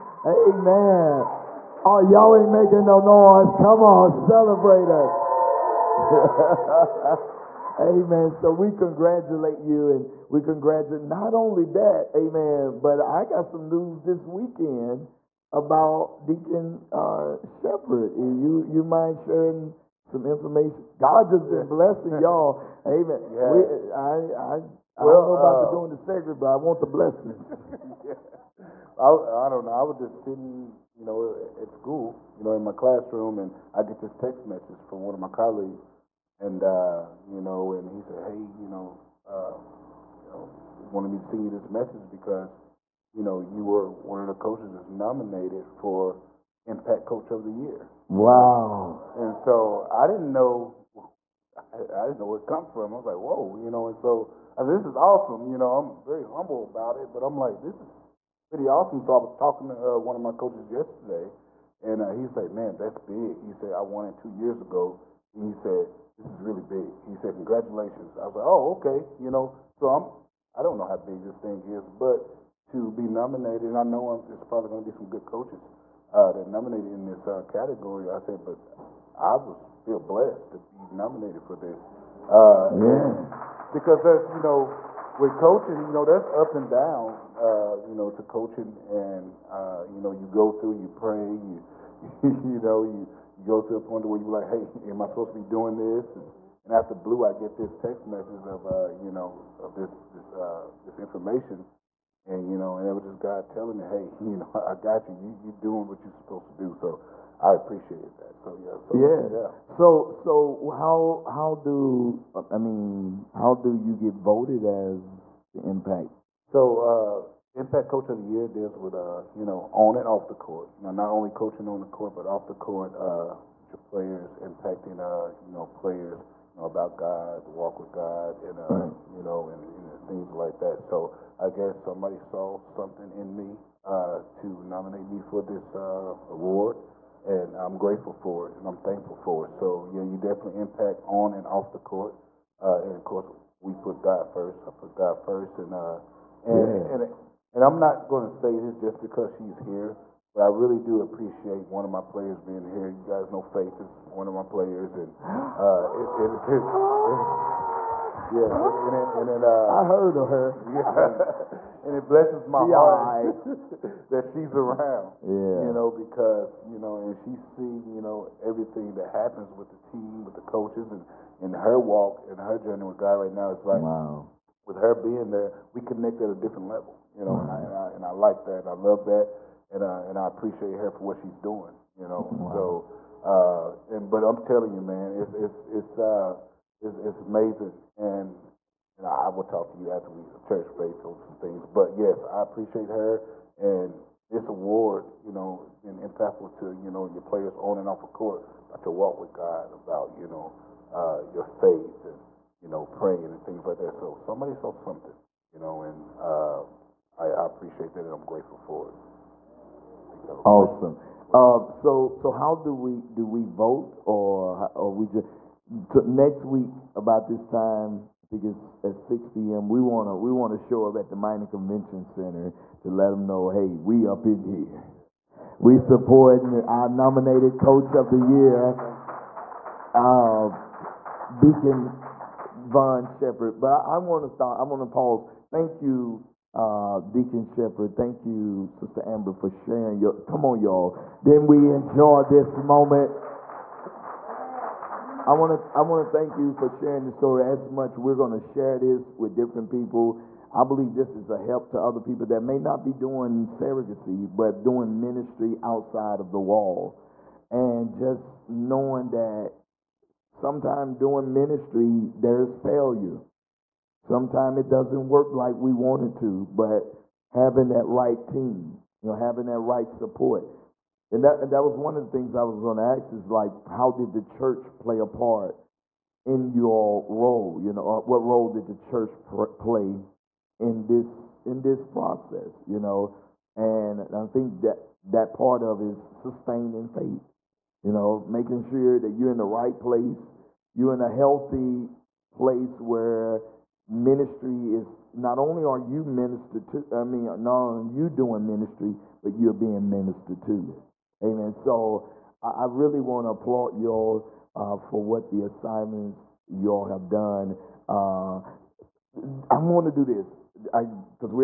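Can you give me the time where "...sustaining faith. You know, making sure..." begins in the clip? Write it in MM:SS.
04:45.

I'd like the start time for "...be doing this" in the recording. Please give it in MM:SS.
01:35.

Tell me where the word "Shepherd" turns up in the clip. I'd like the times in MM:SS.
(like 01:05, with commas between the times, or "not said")
00:17, 03:53, 03:57.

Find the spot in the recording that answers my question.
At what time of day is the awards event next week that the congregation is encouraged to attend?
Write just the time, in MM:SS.
03:38.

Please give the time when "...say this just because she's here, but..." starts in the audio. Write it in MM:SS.
02:28.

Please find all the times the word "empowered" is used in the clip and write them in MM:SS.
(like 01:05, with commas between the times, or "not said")
not said.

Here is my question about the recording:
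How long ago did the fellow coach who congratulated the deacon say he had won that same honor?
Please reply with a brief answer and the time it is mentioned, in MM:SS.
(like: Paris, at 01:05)
2 years ago, at 01:04.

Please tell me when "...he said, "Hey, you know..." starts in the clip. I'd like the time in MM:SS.
00:37.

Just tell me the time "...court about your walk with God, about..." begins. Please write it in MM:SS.
03:18.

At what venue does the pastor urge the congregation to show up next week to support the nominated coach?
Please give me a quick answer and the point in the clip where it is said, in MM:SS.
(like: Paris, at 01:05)
Mining Convention Center, at 03:41.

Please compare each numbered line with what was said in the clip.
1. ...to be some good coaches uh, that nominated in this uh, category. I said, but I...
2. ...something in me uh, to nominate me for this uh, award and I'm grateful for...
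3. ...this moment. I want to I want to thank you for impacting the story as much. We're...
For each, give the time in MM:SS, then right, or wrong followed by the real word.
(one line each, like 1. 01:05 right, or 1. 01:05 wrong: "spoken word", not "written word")
1. 01:14 right
2. 02:12 right
3. 04:02 wrong: "sharing", not "impacting".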